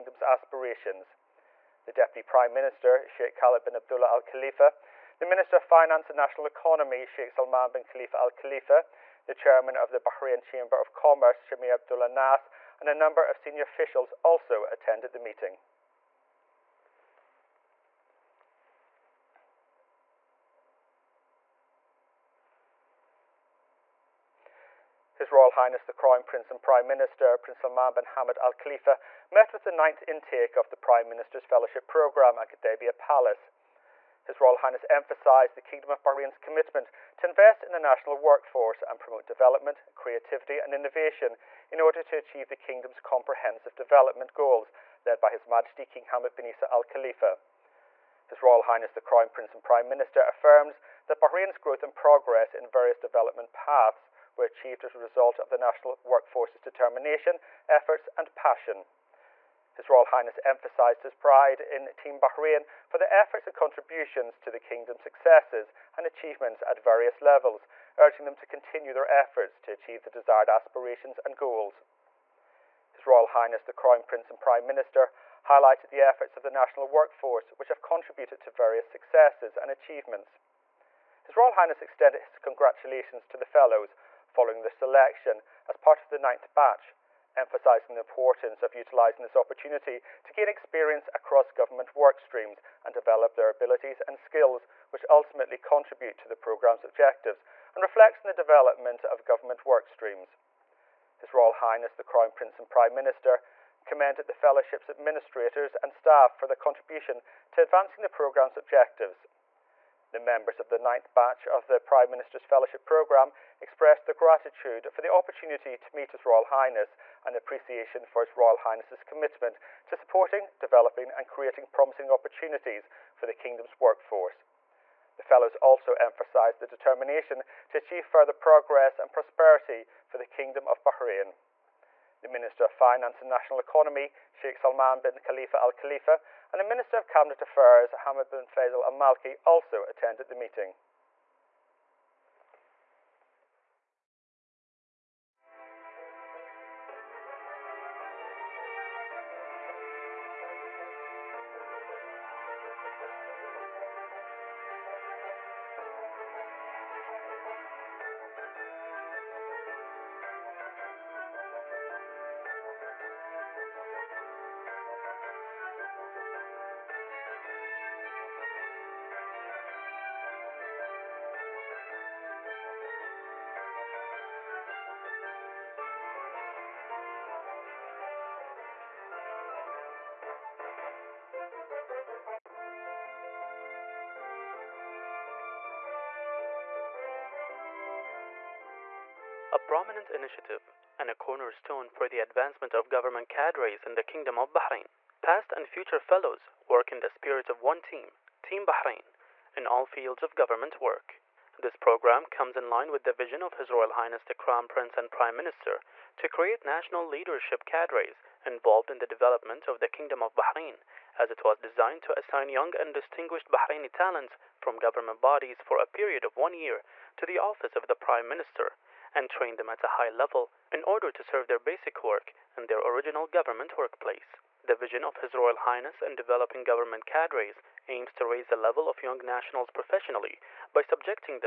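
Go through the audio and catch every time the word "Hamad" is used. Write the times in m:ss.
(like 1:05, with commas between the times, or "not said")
0:28, 0:46, 2:17.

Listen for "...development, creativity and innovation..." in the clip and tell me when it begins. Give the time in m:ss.
0:39.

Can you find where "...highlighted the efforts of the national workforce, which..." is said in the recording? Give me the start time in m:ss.
1:15.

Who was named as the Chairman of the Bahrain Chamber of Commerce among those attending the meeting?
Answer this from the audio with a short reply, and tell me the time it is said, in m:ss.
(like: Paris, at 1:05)
Samir Abdullah Nass, at 0:11.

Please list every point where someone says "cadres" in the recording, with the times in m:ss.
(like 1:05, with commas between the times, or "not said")
3:13, 3:27, 3:47.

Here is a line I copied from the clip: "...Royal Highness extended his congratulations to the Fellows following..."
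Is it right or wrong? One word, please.
right.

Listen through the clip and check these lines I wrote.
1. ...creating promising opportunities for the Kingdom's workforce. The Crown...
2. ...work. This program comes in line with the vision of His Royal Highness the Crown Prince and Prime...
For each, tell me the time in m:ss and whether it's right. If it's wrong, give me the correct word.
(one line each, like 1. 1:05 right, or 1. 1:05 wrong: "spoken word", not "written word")
1. 2:01 wrong: "Fellows", not "Crown"
2. 3:20 right.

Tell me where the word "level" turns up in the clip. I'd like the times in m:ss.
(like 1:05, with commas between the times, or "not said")
1:07, 3:40, 3:48.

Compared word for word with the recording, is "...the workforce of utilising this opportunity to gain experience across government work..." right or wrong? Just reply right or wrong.
wrong.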